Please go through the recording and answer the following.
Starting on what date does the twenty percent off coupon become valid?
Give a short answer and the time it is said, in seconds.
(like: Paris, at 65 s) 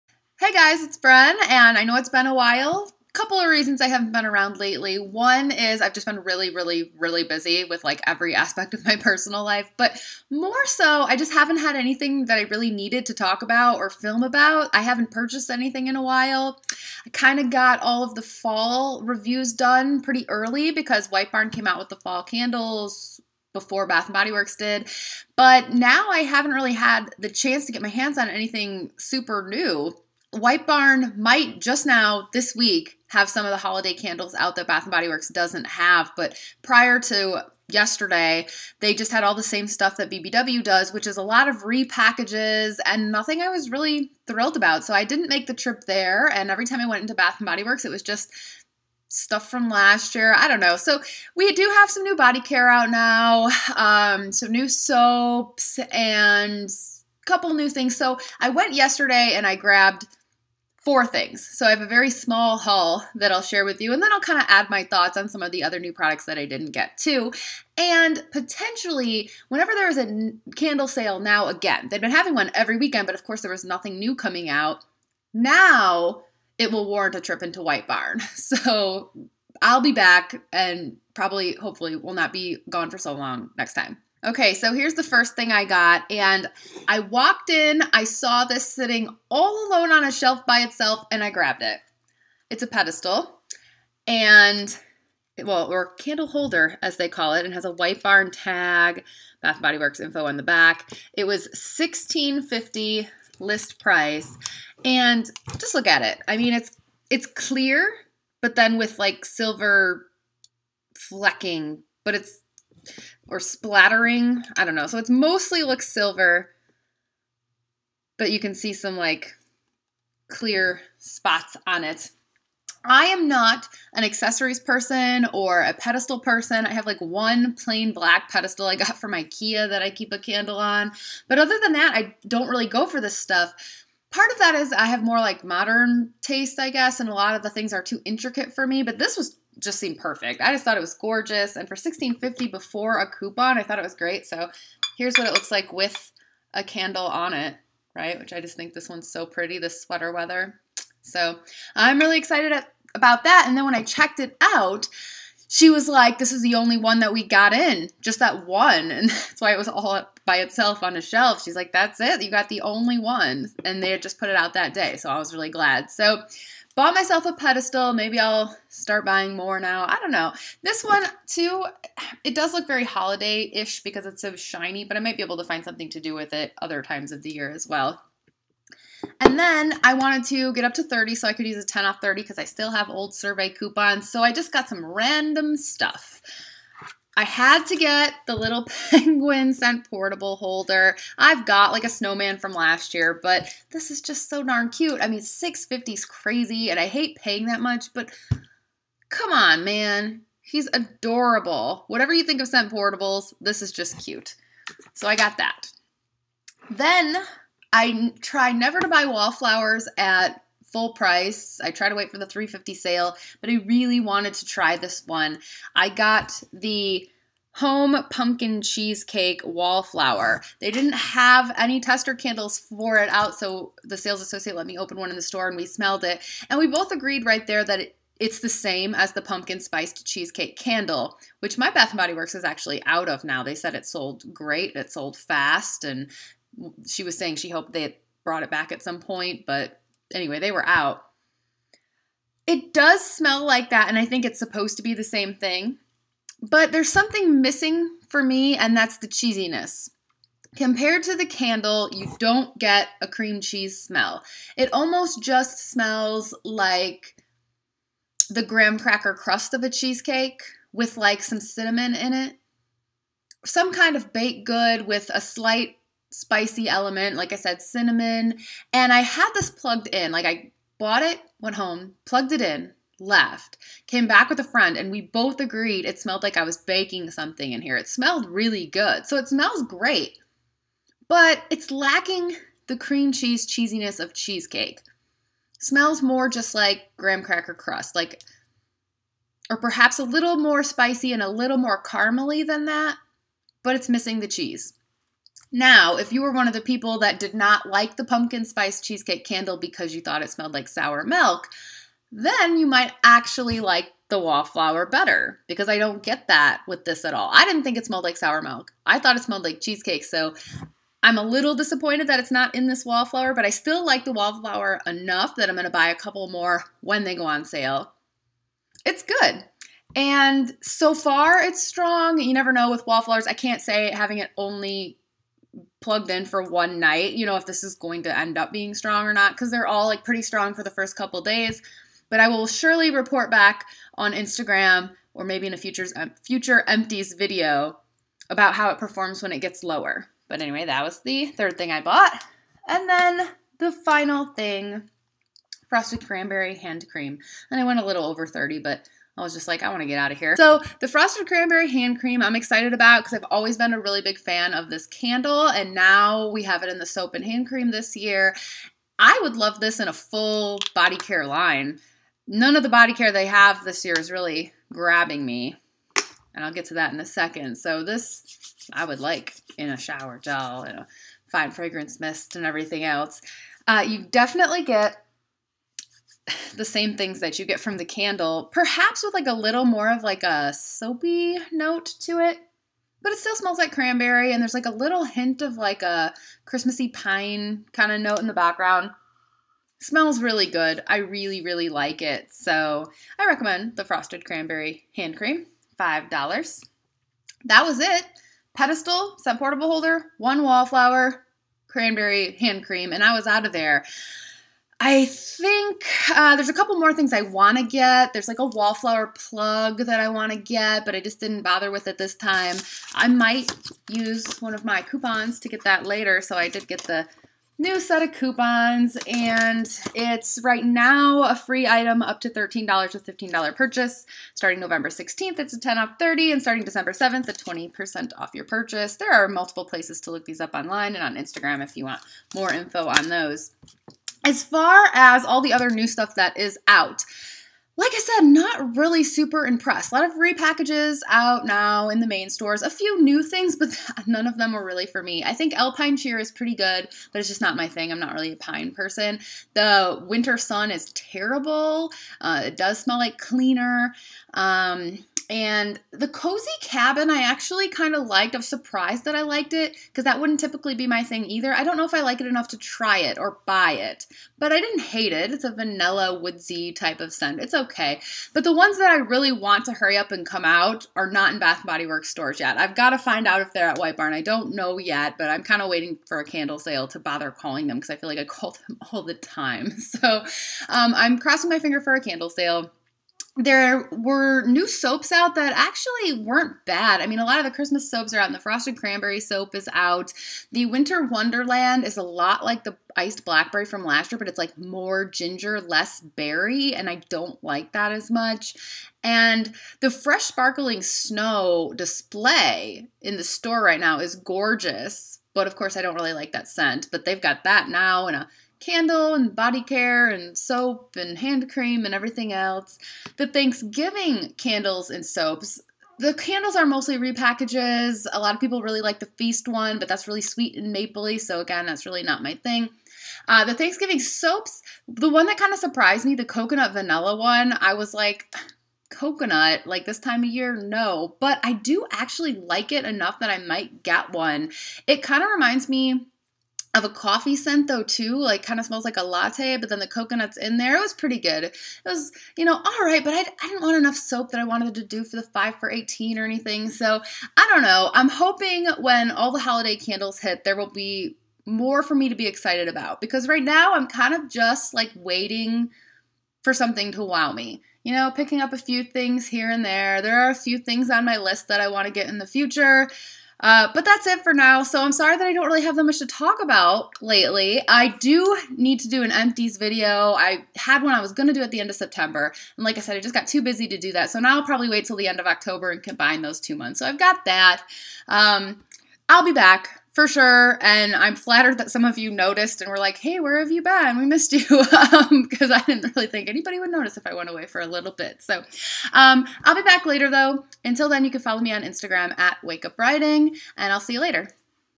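December 7th, at 426 s.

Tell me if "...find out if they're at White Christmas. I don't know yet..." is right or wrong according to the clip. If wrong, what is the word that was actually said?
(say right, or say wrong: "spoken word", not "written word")
wrong: "Barn", not "Christmas".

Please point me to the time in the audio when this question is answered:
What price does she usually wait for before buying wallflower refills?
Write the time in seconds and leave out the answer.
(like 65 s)
212 s.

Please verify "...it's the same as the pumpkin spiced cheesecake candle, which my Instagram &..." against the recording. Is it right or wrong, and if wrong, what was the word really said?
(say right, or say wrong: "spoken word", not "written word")
wrong: "Bath", not "Instagram".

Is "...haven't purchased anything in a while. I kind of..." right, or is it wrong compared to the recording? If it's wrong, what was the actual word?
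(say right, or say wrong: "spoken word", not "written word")
right.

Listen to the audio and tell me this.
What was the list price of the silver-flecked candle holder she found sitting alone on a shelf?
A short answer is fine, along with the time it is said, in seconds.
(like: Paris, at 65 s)
$16.50, at 101 s.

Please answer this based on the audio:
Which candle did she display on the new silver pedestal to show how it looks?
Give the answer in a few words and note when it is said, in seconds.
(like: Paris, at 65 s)
Sweater Weather, at 149 s.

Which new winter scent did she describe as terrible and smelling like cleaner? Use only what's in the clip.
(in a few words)
Winter Sun.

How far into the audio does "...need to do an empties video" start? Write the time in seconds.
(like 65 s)
568 s.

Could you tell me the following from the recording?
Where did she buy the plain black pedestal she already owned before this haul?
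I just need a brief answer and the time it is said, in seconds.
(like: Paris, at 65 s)
IKEA, at 129 s.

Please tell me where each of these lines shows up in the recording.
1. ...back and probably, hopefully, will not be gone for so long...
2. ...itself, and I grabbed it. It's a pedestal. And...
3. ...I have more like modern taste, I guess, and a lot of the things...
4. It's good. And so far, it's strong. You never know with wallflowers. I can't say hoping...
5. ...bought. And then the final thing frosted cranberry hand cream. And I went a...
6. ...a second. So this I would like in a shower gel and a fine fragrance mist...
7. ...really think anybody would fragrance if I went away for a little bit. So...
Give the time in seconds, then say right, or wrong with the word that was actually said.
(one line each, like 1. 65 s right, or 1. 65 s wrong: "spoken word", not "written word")
1. 79 s right
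2. 90 s right
3. 134 s right
4. 318 s wrong: "having", not "hoping"
5. 341 s right
6. 366 s right
7. 585 s wrong: "notice", not "fragrance".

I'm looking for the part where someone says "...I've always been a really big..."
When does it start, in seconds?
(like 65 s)
353 s.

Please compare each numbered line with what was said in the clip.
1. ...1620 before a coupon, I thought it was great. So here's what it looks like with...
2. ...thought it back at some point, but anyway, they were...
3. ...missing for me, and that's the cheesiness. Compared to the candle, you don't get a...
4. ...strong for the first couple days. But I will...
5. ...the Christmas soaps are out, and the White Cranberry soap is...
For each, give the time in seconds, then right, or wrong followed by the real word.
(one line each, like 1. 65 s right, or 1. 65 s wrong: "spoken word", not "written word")
1. 141 s wrong: "1650", not "1620"
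2. 238 s wrong: "brought", not "thought"
3. 247 s right
4. 330 s right
5. 487 s wrong: "Frosted", not "White".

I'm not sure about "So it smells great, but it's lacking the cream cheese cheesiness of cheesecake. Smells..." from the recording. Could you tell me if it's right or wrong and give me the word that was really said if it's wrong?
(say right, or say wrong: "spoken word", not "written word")
right.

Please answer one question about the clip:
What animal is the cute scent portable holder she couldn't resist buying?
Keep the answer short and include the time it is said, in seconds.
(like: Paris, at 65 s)
Penguin, at 188 s.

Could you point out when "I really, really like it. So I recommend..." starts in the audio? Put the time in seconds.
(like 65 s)
390 s.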